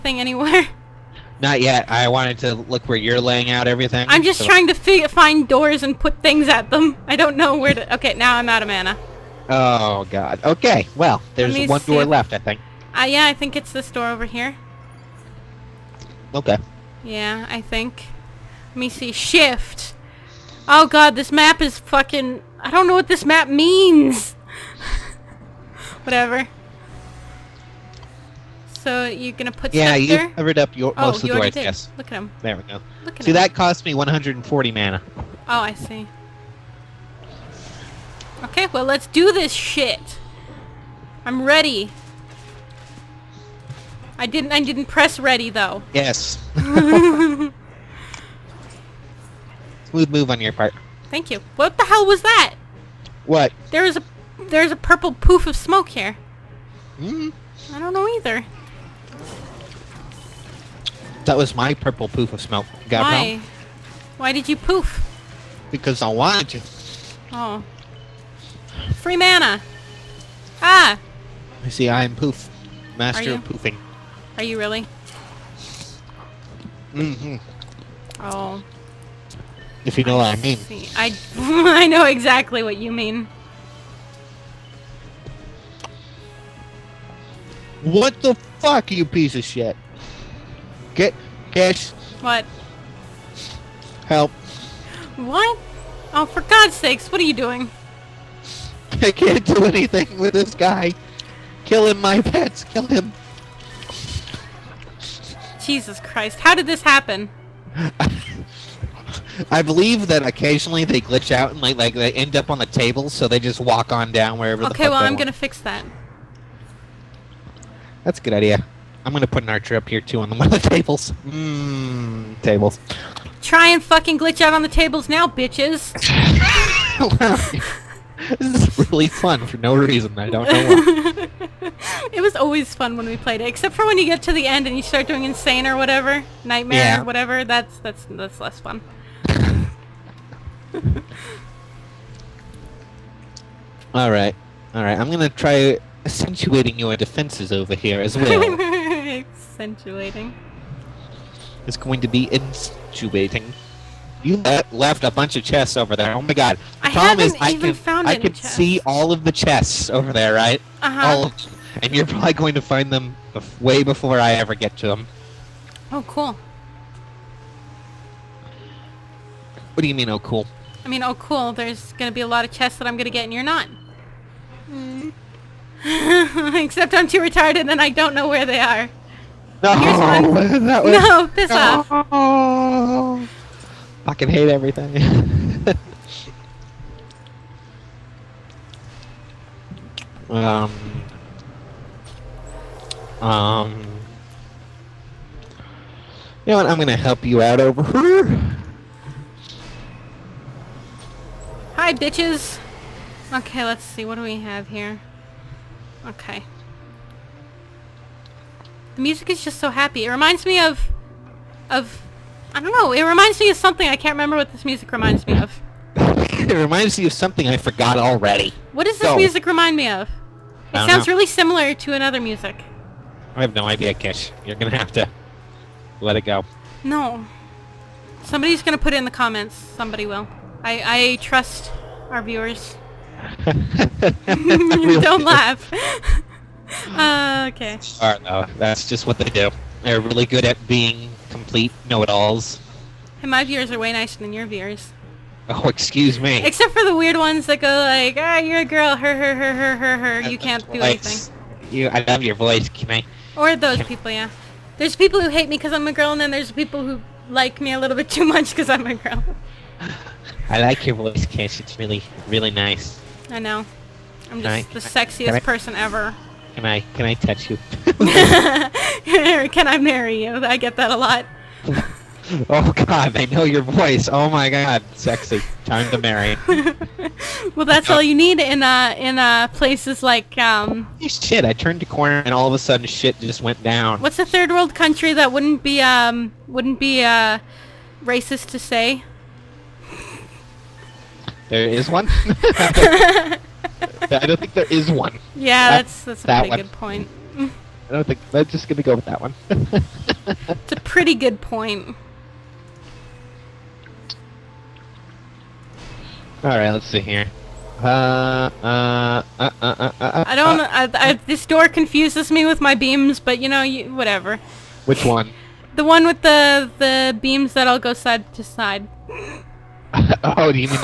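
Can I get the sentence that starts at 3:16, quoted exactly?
I'm gonna help you out over here.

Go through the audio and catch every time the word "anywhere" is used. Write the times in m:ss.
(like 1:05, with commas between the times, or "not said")
0:00.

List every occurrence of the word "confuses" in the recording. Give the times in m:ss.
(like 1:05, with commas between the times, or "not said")
5:11.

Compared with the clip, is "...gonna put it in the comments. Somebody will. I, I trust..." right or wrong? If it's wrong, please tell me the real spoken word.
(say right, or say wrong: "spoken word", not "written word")
right.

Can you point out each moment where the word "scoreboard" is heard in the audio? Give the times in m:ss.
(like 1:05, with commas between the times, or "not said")
not said.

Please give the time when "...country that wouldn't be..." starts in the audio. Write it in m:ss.
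4:44.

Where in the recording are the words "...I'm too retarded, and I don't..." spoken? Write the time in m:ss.
2:56.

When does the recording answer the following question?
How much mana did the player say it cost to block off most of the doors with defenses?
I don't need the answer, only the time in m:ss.
0:33.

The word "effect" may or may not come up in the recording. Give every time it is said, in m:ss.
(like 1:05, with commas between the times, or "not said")
not said.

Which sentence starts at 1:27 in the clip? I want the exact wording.
What the fuck, you piece of shit?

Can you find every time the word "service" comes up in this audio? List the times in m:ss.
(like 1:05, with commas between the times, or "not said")
not said.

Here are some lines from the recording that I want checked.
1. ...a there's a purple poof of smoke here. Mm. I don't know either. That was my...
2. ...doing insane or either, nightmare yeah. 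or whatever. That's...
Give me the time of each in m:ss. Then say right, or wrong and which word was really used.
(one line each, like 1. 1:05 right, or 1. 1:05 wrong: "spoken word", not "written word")
1. 0:53 right
2. 2:15 wrong: "whatever", not "either".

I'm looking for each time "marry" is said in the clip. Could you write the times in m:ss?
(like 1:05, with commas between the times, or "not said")
4:29, 4:35.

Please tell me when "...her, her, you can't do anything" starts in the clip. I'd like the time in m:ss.
4:09.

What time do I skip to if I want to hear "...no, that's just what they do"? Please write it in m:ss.
3:58.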